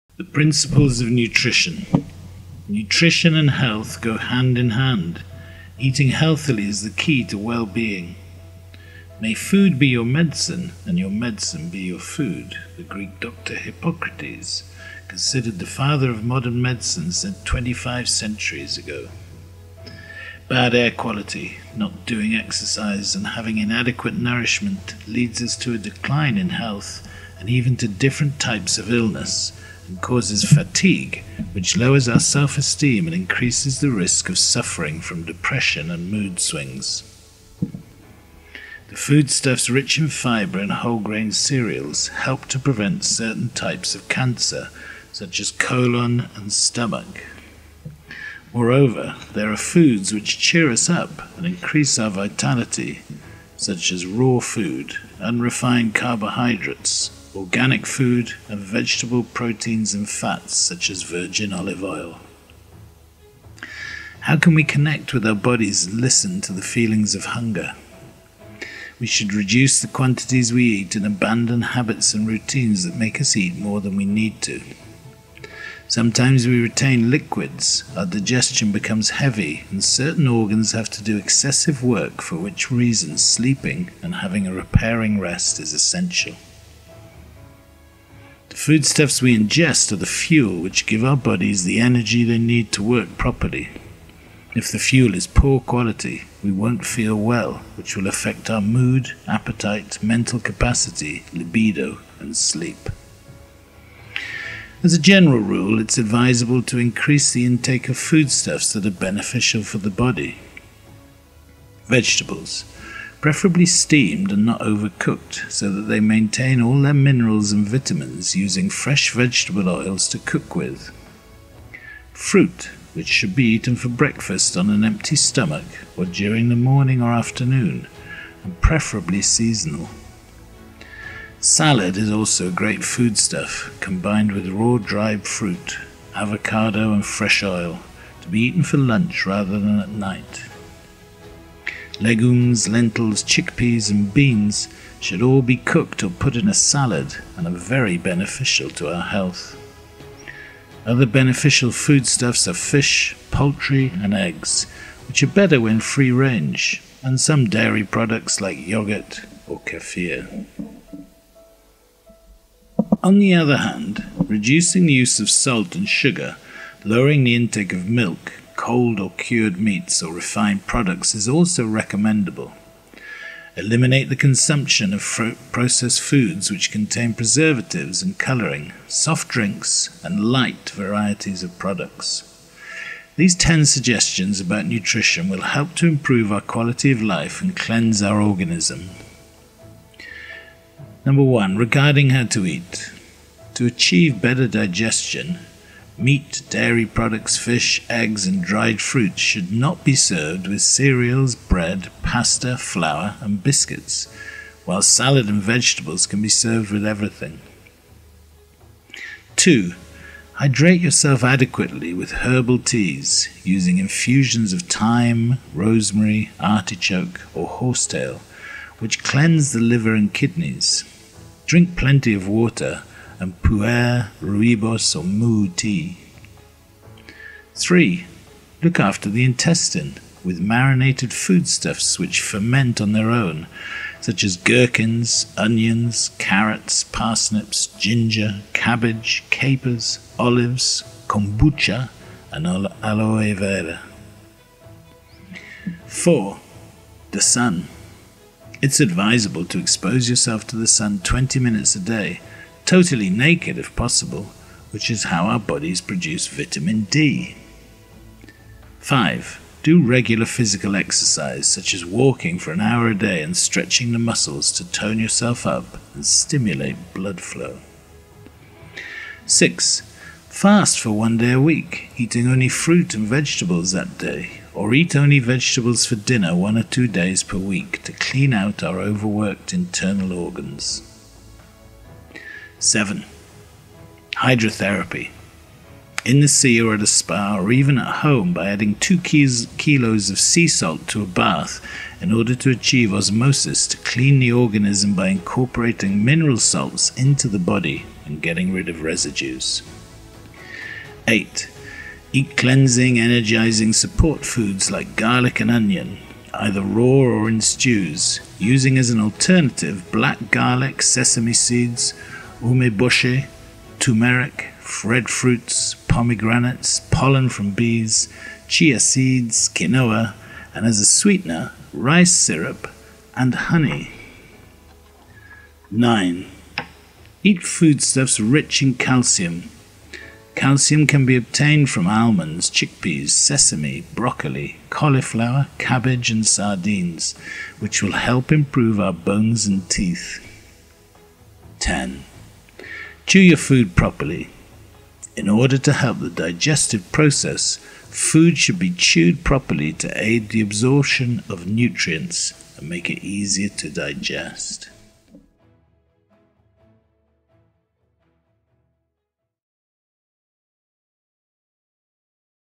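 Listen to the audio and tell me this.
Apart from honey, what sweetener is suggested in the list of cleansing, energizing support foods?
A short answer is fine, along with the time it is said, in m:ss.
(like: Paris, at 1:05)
rice syrup, at 5:21.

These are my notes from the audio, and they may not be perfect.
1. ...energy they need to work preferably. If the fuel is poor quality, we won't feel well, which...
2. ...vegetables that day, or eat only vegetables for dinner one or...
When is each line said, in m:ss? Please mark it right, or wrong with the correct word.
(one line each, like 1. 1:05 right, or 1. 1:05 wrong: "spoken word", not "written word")
1. 1:31 wrong: "properly", not "preferably"
2. 4:33 right.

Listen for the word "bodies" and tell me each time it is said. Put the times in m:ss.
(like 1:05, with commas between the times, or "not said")
1:05, 1:31, 4:15.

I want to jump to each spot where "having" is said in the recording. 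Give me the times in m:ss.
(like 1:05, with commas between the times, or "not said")
0:23, 1:24.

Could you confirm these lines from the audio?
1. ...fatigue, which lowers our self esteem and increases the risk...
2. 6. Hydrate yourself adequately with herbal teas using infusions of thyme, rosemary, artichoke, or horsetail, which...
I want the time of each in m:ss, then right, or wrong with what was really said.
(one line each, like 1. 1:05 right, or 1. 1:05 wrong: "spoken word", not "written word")
1. 0:30 right
2. 3:29 wrong: "2", not "6".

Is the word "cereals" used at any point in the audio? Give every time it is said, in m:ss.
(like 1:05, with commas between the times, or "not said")
0:41, 3:20.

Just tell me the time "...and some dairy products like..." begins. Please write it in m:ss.
2:37.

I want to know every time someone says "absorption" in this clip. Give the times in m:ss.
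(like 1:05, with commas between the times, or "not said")
5:50.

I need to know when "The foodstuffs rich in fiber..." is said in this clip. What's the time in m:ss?
0:37.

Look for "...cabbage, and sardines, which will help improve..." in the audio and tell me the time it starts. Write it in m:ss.
5:35.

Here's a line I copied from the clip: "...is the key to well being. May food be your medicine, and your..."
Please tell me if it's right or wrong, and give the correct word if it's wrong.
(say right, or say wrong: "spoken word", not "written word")
right.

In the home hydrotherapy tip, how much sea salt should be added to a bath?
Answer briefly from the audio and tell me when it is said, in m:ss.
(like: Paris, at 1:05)
2 kilos, at 4:48.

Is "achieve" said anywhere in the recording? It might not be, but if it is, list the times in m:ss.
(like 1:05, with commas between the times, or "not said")
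3:13, 4:52.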